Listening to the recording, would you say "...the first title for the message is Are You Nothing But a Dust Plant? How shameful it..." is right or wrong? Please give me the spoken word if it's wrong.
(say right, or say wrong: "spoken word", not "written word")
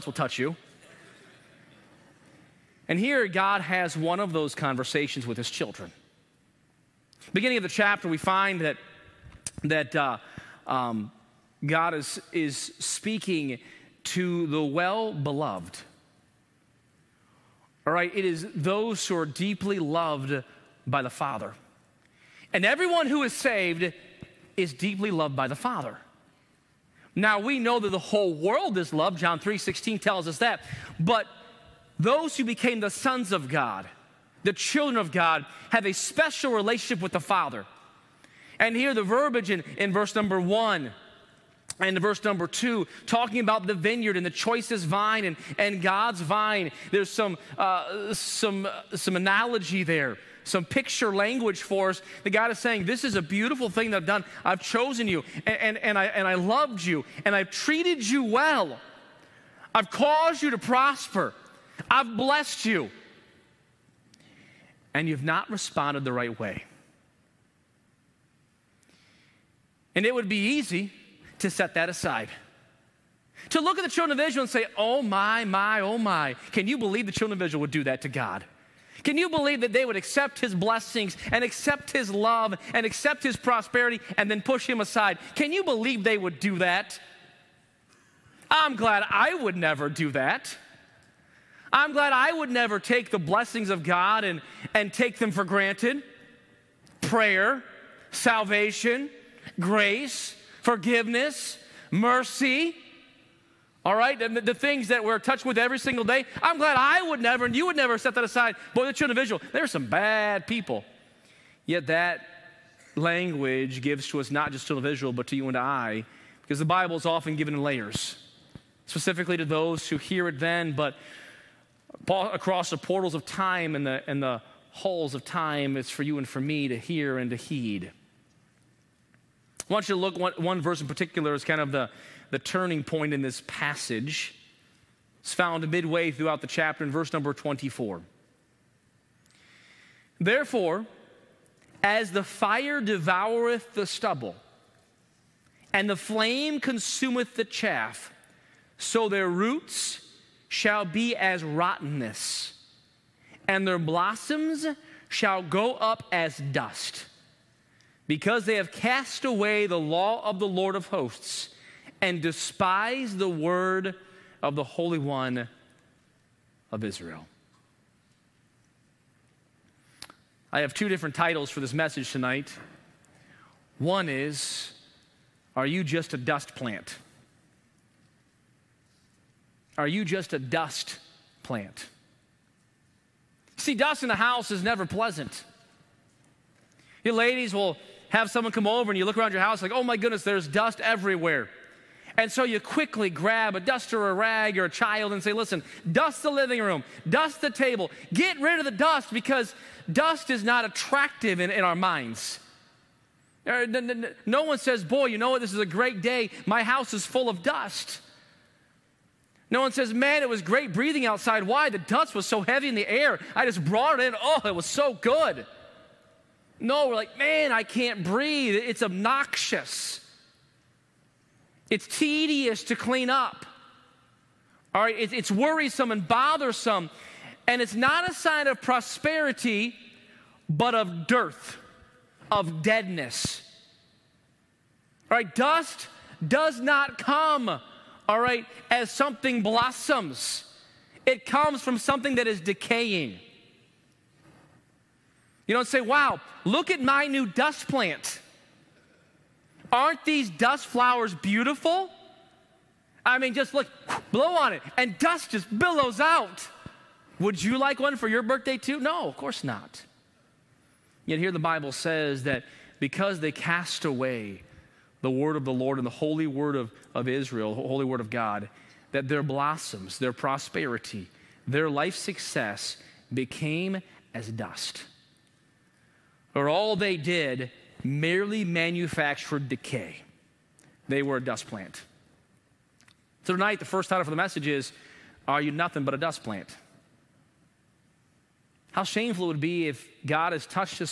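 right.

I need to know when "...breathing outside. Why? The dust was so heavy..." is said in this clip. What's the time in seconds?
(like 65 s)
210 s.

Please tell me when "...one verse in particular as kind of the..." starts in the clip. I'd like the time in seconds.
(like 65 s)
130 s.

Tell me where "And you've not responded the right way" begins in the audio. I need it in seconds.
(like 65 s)
64 s.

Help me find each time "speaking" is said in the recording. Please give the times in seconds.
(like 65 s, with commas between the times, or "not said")
12 s.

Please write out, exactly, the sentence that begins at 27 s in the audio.
Now we know that the whole world is loved.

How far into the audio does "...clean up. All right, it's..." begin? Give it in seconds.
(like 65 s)
222 s.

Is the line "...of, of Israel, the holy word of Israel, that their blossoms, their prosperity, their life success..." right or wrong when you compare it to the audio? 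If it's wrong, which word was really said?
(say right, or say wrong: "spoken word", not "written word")
wrong: "God", not "Israel".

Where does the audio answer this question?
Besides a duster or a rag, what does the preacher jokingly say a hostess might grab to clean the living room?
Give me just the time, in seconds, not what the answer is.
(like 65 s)
194 s.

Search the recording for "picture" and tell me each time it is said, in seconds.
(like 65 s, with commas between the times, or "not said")
50 s.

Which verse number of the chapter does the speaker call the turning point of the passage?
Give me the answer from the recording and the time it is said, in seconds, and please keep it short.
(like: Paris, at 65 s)
24, at 136 s.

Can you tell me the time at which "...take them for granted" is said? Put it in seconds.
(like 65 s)
94 s.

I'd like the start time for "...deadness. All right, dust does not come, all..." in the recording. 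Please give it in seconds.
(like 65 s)
232 s.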